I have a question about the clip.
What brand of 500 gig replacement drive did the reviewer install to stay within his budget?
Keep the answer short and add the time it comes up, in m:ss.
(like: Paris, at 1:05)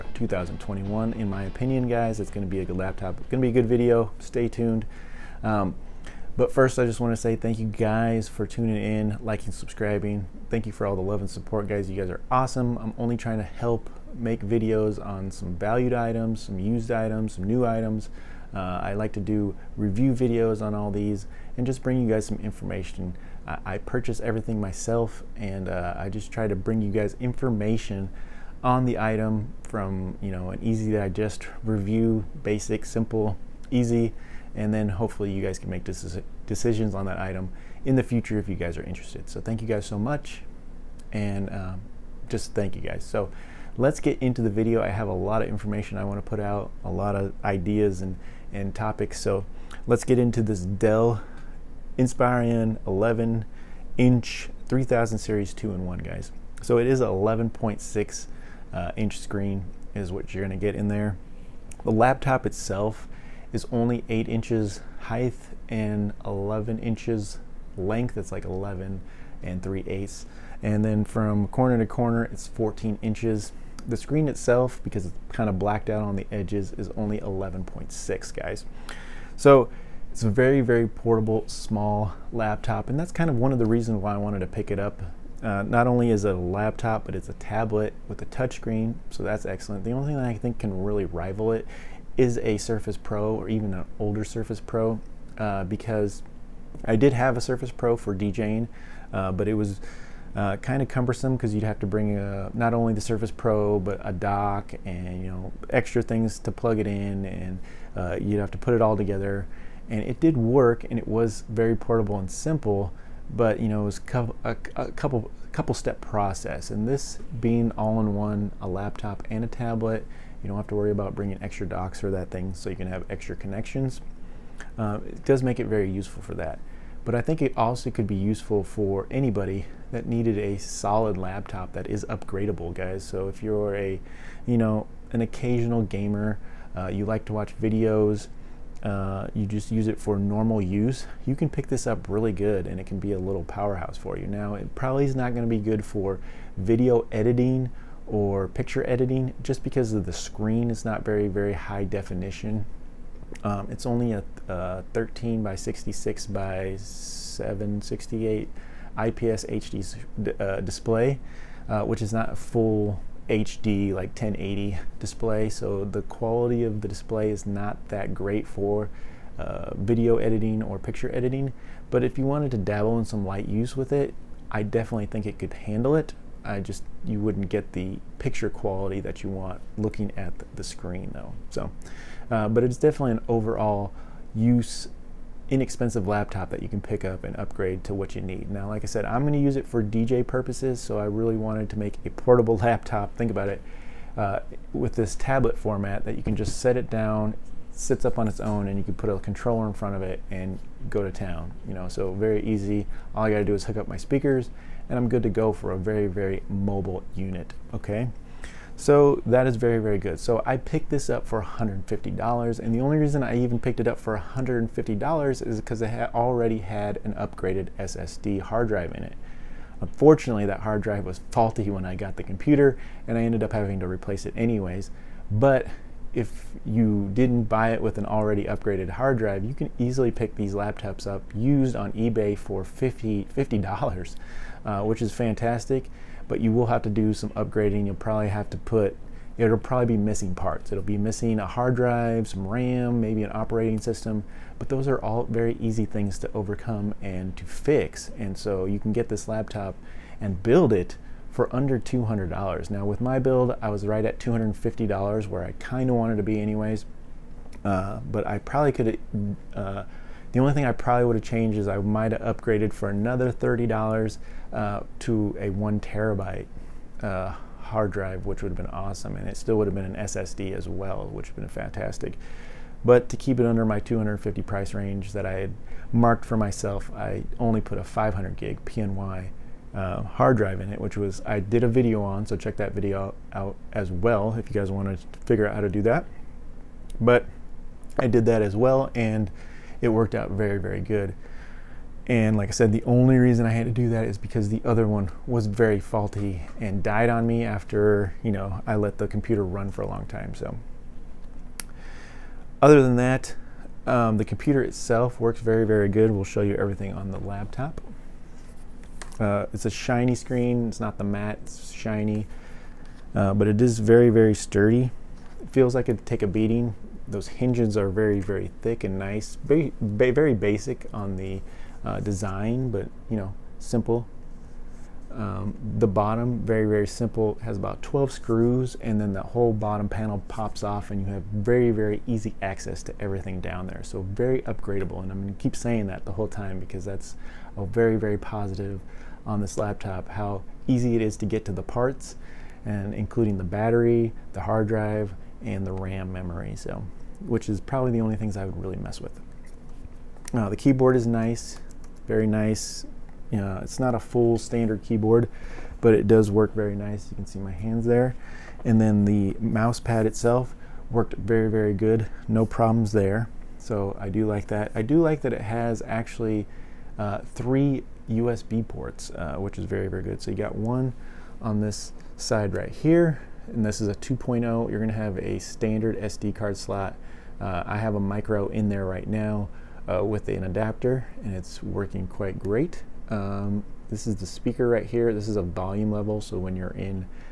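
PNY, at 4:38.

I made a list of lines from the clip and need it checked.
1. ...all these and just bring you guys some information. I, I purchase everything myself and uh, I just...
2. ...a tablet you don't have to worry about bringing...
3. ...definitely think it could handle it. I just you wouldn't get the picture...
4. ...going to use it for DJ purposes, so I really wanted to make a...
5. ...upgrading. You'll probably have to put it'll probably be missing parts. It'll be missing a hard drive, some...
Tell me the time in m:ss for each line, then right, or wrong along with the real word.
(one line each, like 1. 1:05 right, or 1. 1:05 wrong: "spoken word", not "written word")
1. 0:20 right
2. 1:59 right
3. 2:54 right
4. 3:09 right
5. 3:57 right.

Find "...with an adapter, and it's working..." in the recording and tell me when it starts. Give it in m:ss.
6:20.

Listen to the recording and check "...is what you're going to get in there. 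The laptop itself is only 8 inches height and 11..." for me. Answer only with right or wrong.
right.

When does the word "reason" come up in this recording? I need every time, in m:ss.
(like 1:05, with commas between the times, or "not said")
1:23, 3:32, 4:53.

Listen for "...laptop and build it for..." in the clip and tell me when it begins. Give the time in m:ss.
4:09.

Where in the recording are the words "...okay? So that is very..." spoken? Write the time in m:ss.
3:27.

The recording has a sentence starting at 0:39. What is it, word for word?
So thank you guys so much, and um, just thank you guys.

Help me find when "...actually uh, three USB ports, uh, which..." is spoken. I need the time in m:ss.
6:05.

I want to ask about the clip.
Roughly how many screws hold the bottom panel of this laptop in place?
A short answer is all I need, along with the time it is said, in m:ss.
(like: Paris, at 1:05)
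12, at 5:27.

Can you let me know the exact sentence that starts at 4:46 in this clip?
But I did that as well, and it worked out very, very good.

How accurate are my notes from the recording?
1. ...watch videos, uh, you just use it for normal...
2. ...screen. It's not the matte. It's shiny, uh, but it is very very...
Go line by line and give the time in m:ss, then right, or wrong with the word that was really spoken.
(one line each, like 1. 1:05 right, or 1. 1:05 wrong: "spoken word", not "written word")
1. 2:17 right
2. 5:10 right.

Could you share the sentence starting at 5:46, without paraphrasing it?
So, which is probably the only things I would really mess with.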